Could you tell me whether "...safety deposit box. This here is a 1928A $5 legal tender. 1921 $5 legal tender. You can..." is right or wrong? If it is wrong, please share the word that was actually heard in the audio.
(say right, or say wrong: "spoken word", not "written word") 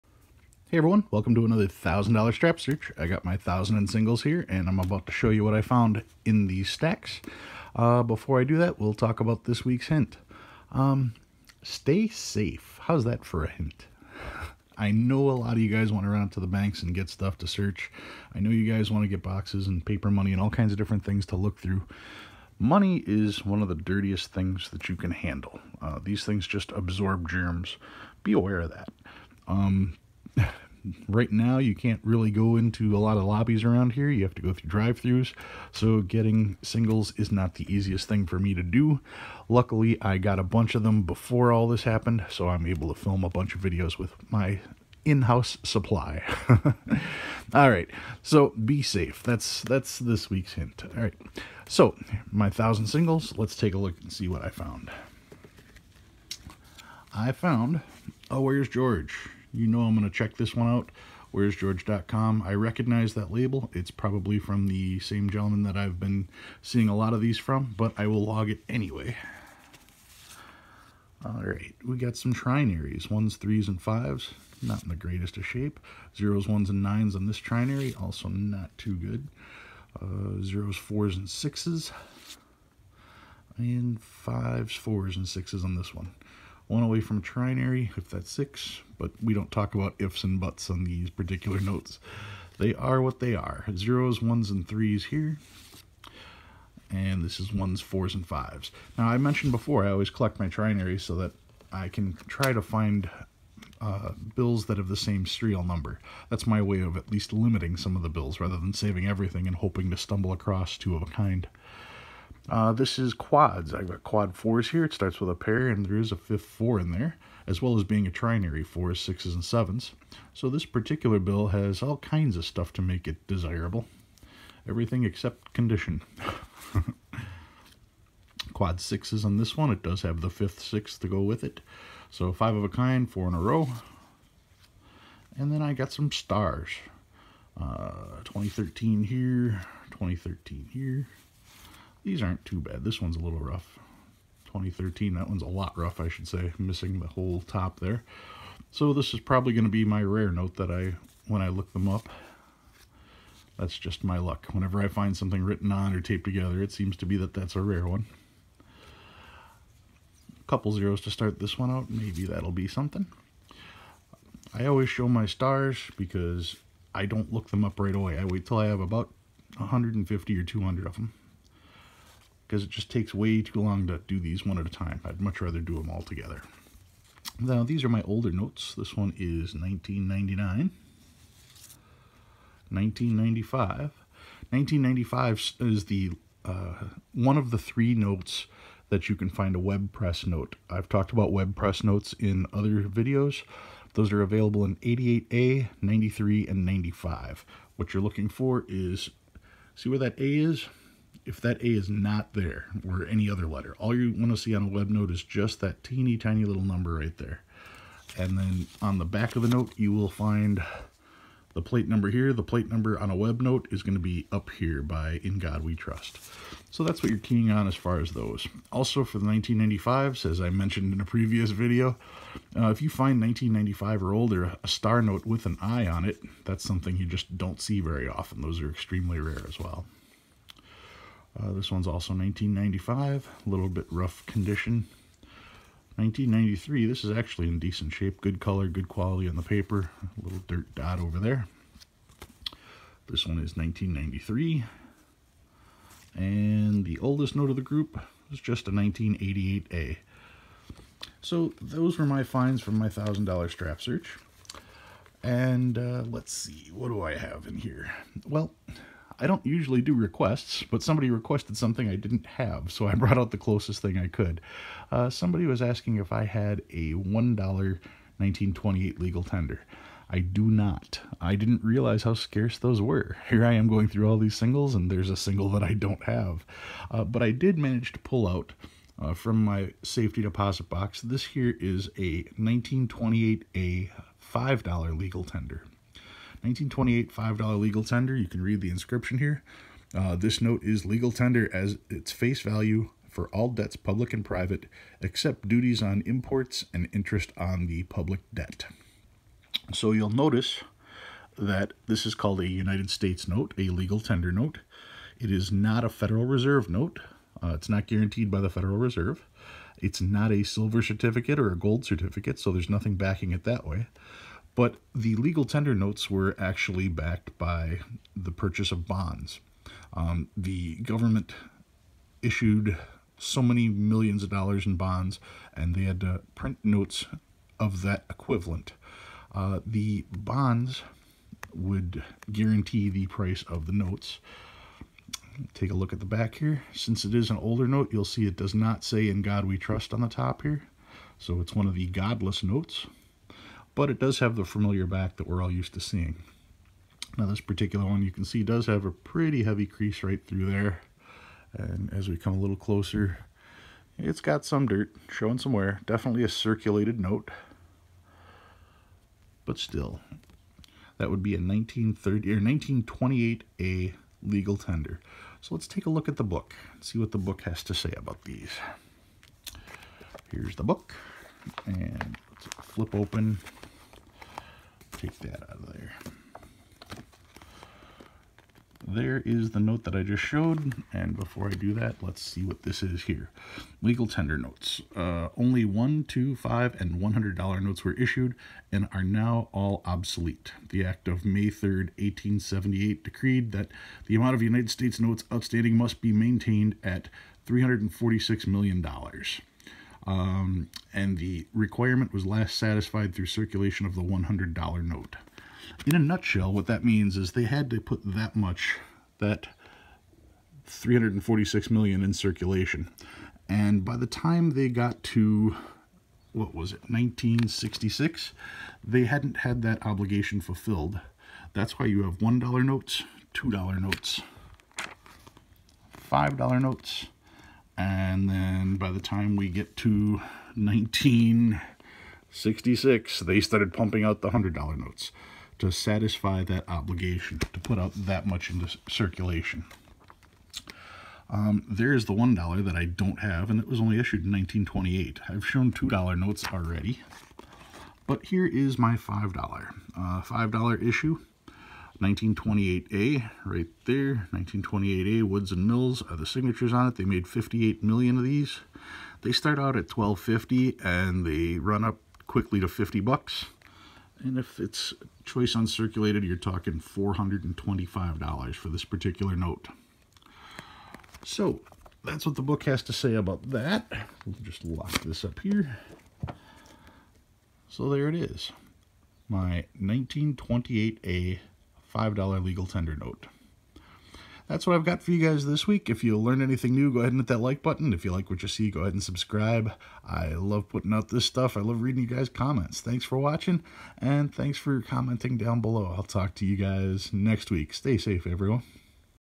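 wrong: "1928", not "1921".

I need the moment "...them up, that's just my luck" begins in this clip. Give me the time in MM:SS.
02:31.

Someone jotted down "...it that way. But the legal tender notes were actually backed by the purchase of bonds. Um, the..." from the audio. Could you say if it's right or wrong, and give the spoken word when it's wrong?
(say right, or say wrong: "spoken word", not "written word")
right.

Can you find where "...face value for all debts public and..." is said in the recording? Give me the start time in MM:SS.
04:52.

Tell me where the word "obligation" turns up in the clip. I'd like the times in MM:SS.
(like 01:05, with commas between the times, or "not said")
06:59, 07:16.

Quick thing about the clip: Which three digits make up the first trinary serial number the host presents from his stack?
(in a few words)
Ones, threes, and fives.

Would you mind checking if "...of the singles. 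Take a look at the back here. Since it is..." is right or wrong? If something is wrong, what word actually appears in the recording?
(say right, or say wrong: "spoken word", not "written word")
wrong: "notes", not "singles".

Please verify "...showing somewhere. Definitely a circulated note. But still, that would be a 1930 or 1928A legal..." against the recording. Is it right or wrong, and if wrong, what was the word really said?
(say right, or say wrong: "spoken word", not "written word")
right.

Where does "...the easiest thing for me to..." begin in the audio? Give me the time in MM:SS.
00:37.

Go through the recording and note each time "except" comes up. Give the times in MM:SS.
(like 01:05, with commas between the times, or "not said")
02:05, 04:55.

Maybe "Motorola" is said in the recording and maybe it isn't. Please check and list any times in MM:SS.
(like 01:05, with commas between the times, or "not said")
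not said.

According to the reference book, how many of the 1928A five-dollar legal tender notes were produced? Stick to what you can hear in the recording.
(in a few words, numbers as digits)
58 million.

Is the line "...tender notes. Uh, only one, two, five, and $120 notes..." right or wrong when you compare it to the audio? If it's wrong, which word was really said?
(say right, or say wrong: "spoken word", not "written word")
wrong: "100", not "120".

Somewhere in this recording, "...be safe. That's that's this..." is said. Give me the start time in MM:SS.
00:48.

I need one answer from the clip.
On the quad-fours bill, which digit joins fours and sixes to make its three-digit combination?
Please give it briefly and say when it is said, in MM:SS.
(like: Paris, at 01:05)
sevens, at 01:59.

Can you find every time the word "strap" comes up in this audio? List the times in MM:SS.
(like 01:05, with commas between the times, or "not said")
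00:02, 04:13.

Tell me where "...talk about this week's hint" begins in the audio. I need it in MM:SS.
00:08.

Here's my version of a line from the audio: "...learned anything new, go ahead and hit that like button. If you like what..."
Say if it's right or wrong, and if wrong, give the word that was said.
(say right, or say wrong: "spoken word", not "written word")
right.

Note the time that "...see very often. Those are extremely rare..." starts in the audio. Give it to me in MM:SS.
03:47.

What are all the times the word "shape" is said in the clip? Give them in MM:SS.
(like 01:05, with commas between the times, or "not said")
01:15, 03:57.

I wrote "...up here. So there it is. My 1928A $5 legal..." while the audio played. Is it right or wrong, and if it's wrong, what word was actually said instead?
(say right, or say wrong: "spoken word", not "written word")
right.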